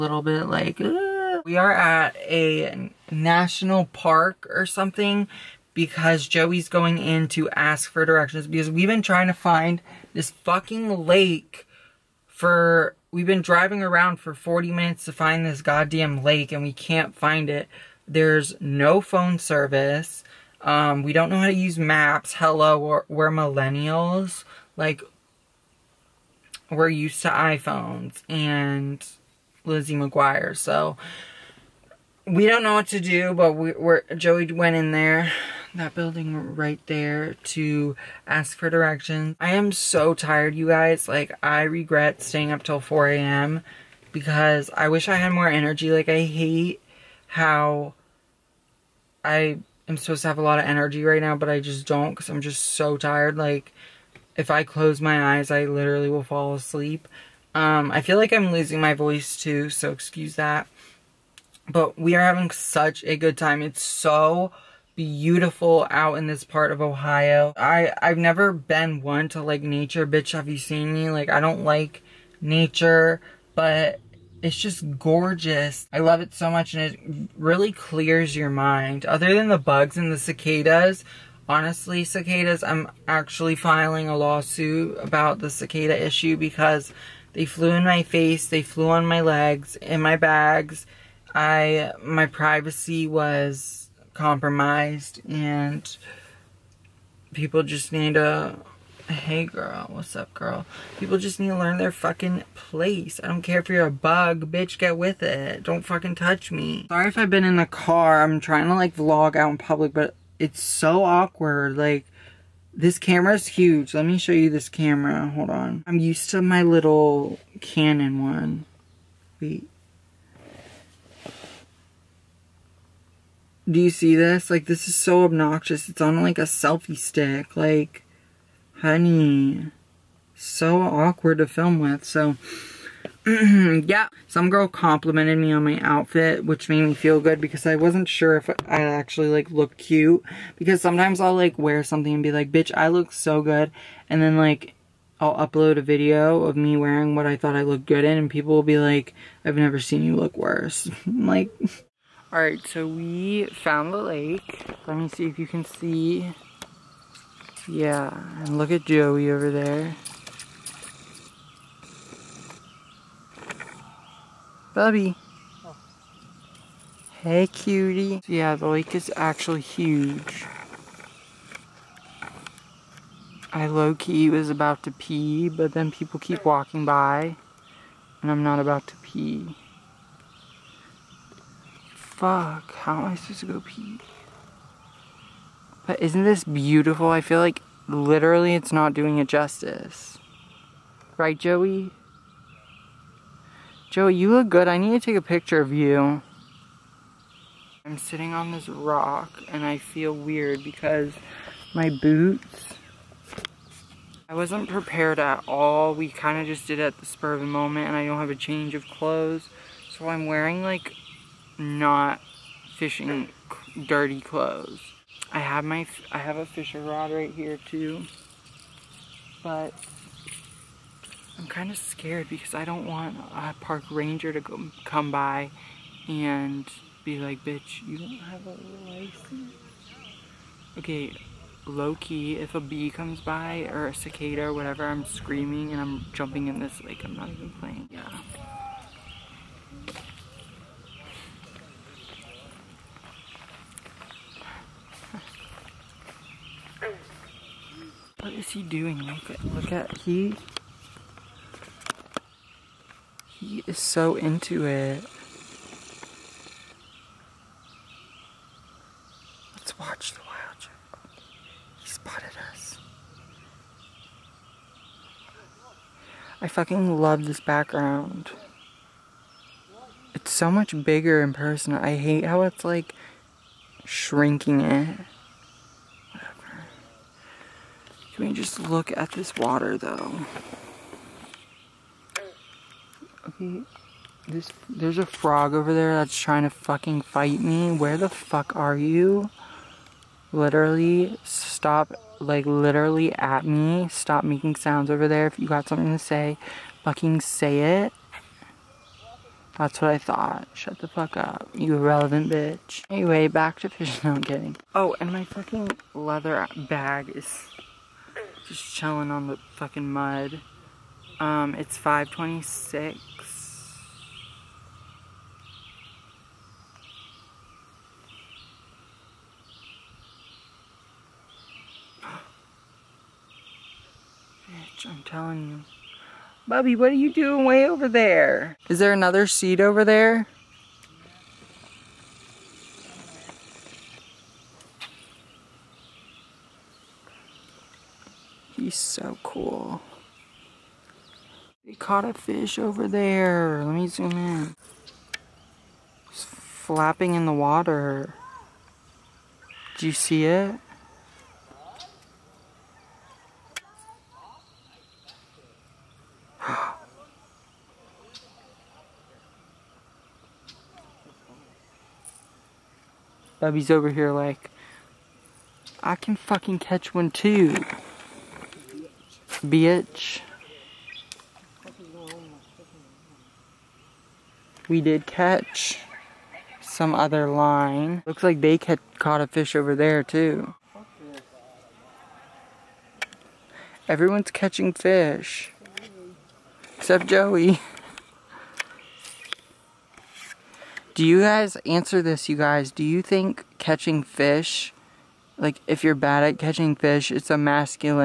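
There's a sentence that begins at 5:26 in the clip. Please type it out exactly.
Bubby, what are you doing way over there?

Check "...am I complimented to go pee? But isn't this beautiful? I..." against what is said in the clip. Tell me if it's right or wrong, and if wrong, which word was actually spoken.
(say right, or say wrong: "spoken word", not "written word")
wrong: "supposed", not "complimented".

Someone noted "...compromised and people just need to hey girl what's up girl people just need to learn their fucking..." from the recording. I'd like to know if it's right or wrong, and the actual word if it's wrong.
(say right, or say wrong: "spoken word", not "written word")
right.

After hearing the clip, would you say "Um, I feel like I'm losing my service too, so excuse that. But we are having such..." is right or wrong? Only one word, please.
wrong.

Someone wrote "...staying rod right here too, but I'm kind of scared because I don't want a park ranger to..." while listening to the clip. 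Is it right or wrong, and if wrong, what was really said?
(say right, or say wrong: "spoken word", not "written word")
wrong: "fishing", not "staying".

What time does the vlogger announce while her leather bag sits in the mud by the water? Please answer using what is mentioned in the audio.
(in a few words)
5:26.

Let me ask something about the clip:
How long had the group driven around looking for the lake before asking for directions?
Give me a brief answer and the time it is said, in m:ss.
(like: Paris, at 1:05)
40 minutes, at 0:14.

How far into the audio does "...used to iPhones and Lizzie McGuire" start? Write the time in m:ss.
0:26.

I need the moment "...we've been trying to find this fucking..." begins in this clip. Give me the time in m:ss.
0:08.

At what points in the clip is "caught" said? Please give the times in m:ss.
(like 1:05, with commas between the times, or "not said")
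5:41, 6:18.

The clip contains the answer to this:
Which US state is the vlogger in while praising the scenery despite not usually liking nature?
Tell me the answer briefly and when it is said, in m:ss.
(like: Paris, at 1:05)
Ohio, at 1:06.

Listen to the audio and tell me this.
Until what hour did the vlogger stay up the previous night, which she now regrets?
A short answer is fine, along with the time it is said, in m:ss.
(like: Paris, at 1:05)
4 a.m., at 0:42.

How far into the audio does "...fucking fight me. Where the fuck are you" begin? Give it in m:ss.
4:46.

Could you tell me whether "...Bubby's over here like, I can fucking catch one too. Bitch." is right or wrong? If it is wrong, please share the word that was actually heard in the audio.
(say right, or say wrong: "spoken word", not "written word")
right.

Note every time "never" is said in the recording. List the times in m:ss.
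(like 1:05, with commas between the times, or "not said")
1:08, 2:29.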